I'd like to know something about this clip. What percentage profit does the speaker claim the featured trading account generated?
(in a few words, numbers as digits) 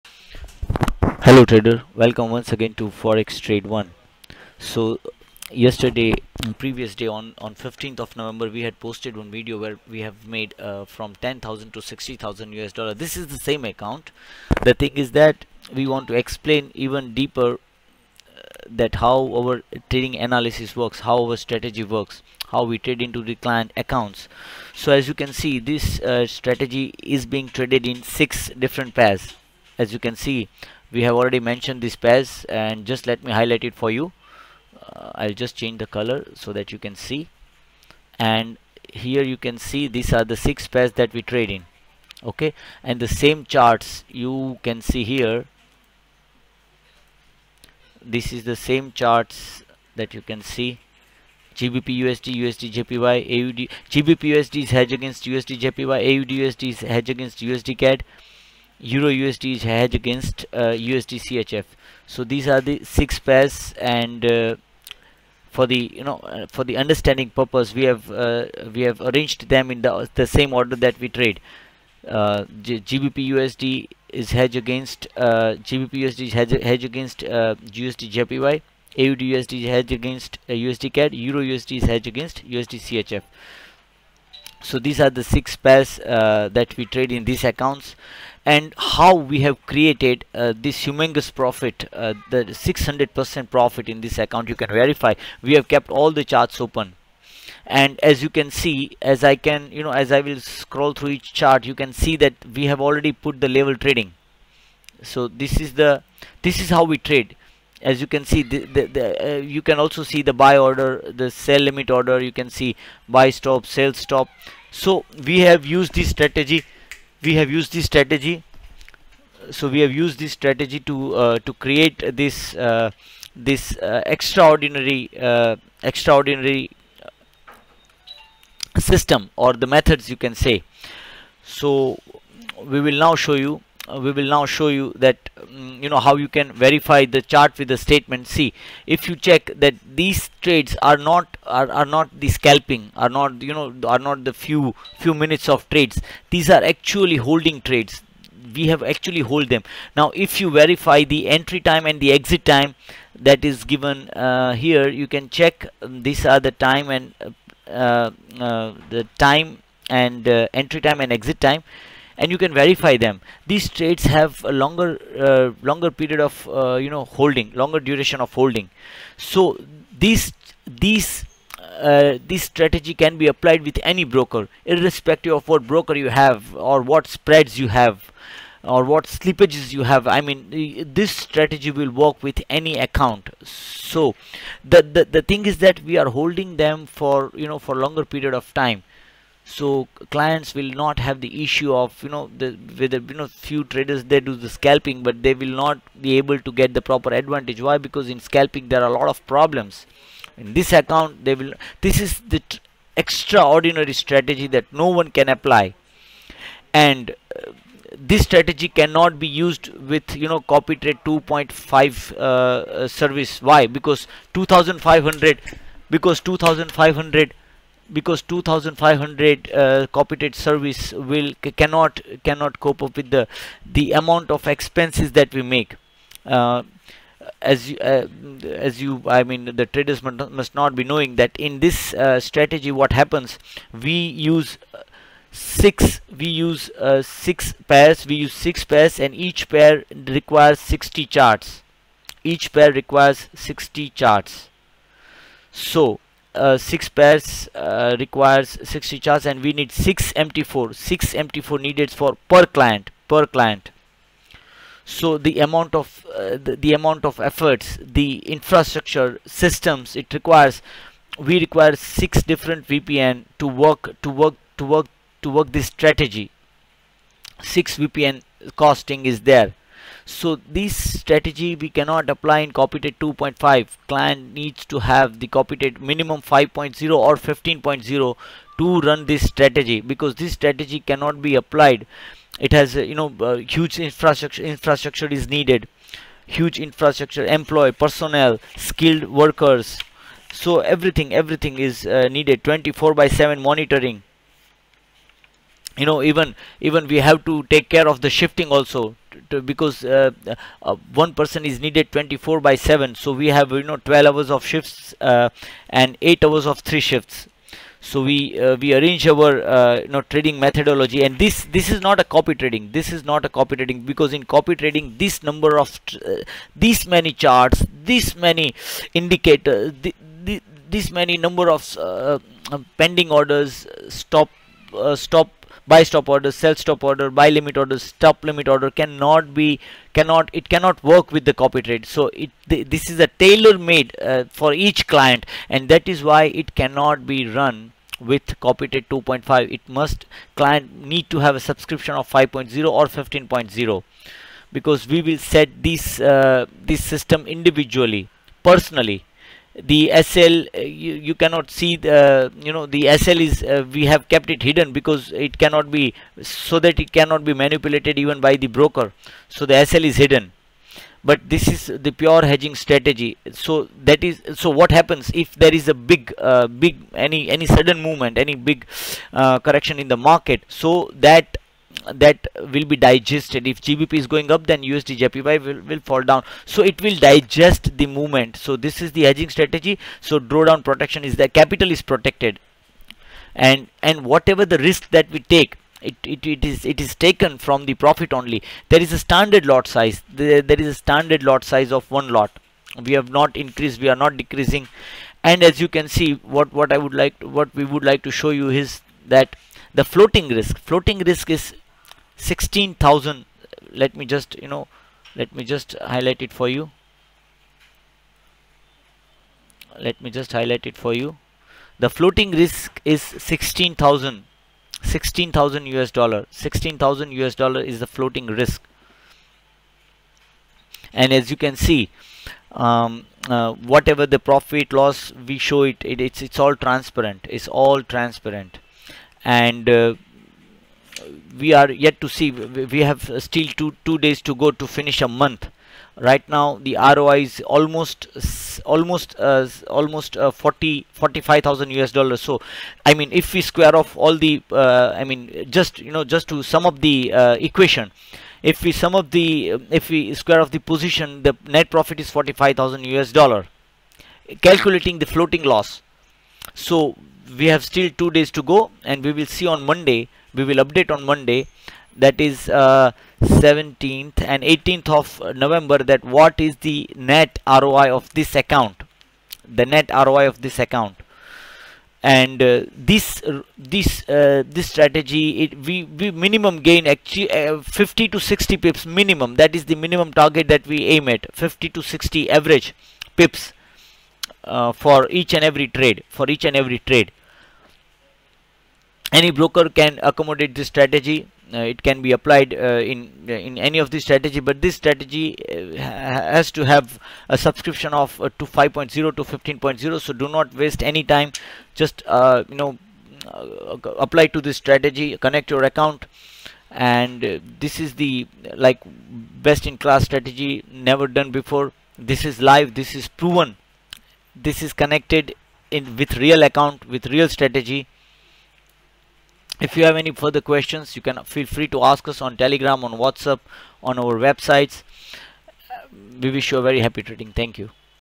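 600%.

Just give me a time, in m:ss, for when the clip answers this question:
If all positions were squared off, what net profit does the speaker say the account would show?
7:32.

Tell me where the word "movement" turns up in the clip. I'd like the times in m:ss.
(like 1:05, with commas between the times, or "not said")
6:07, 6:17.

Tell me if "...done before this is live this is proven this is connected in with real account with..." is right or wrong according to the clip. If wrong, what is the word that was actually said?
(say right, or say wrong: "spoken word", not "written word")
right.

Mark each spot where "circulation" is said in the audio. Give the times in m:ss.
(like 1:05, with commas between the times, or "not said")
not said.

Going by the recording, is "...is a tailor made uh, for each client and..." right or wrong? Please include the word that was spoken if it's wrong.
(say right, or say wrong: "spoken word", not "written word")
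right.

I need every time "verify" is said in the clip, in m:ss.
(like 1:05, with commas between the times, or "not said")
1:34, 2:16, 2:30, 2:42.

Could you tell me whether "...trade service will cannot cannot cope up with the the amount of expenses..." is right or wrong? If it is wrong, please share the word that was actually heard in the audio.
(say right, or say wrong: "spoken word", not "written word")
right.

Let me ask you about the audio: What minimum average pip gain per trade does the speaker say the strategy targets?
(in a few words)
50 to 60 pips.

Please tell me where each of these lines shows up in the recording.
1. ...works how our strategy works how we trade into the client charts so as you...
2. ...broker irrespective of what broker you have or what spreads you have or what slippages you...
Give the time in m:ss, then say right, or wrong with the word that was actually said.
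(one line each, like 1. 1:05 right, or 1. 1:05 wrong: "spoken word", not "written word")
1. 0:20 wrong: "accounts", not "charts"
2. 2:54 right.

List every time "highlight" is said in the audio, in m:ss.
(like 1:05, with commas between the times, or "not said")
0:33, 6:45, 6:50.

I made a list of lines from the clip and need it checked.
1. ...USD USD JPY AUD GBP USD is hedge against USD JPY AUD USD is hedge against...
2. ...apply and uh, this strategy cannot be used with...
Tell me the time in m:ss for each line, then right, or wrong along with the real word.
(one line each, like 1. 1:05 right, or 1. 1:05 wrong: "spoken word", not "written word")
1. 0:51 right
2. 3:25 right.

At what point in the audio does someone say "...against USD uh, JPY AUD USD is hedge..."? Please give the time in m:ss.
1:16.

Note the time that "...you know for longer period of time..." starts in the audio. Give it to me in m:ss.
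3:07.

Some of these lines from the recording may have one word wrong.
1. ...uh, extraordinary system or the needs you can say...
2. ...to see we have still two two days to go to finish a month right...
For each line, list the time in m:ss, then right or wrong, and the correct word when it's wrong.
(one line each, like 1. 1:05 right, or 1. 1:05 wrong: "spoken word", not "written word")
1. 2:05 wrong: "methods", not "needs"
2. 7:12 right.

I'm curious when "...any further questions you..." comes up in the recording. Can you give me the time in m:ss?
8:39.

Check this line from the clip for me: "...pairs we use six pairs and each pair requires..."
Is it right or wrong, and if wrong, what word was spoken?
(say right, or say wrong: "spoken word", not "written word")
right.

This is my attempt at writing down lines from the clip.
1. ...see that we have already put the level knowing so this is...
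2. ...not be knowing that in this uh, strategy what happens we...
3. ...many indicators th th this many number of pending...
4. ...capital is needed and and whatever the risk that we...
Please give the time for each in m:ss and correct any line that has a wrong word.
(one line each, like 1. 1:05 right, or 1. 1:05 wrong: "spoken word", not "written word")
1. 1:41 wrong: "trading", not "knowing"
2. 3:50 right
3. 5:18 right
4. 6:21 wrong: "protected", not "needed".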